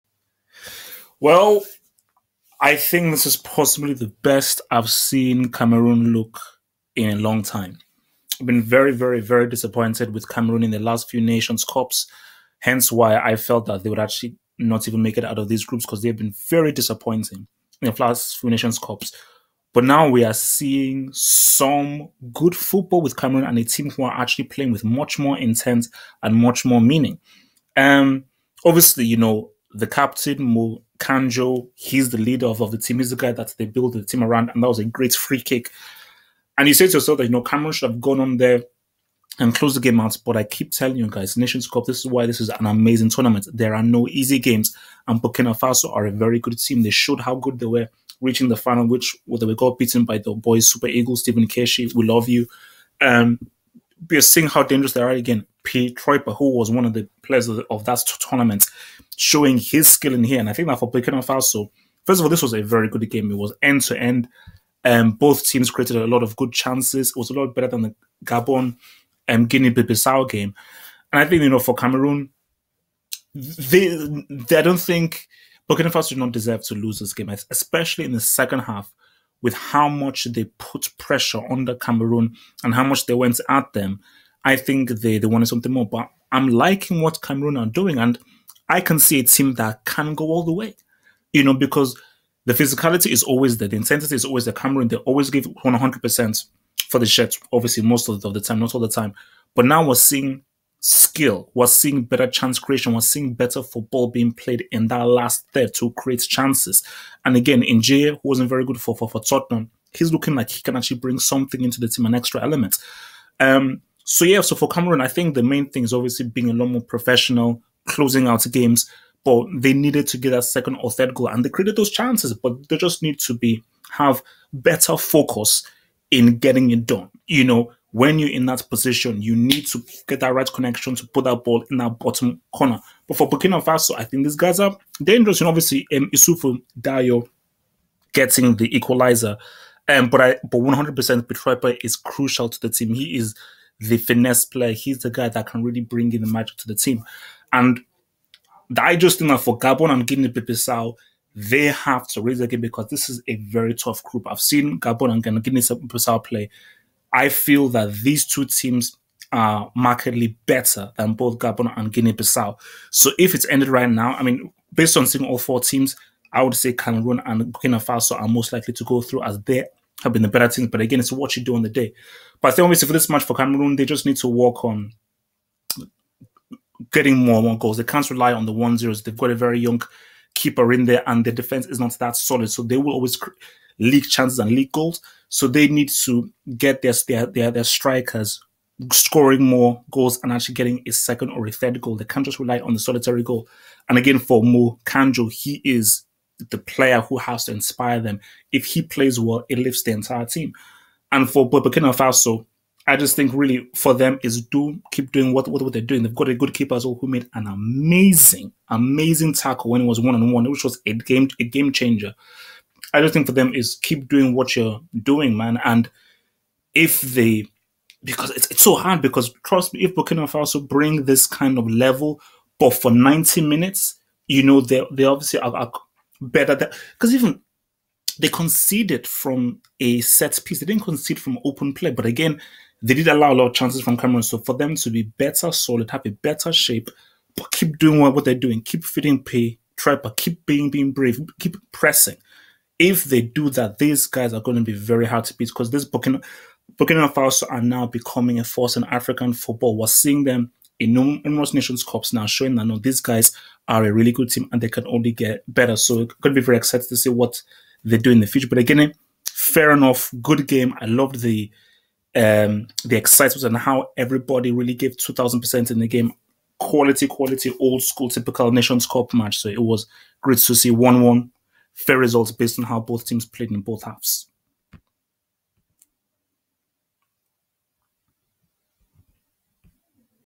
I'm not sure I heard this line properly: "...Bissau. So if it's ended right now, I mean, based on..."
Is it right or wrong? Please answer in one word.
right.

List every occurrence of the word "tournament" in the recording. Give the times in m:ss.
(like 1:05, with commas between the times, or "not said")
0:43, 0:58.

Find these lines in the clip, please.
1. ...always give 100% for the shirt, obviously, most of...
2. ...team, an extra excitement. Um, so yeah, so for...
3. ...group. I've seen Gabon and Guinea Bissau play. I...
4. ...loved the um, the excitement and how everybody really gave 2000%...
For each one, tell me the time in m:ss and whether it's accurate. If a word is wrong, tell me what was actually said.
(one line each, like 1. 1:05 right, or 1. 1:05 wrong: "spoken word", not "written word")
1. 1:34 right
2. 1:51 wrong: "element", not "excitement"
3. 2:34 right
4. 4:20 right.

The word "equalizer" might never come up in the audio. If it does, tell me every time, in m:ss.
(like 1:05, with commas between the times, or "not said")
2:18.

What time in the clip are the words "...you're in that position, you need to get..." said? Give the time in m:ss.
2:08.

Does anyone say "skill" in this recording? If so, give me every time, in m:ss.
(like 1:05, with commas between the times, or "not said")
0:59, 1:40.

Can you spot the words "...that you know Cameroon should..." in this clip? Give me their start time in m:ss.
0:37.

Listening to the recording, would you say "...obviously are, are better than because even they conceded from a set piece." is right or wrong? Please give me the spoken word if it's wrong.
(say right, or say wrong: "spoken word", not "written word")
right.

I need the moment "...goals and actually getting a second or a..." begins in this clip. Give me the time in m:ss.
3:09.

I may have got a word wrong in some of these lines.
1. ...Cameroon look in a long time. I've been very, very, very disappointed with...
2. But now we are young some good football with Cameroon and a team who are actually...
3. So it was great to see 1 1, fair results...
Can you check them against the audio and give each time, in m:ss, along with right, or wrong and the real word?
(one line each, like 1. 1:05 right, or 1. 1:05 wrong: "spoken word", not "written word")
1. 0:05 right
2. 0:19 wrong: "seeing", not "young"
3. 4:29 right.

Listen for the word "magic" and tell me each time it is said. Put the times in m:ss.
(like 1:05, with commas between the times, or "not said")
2:26.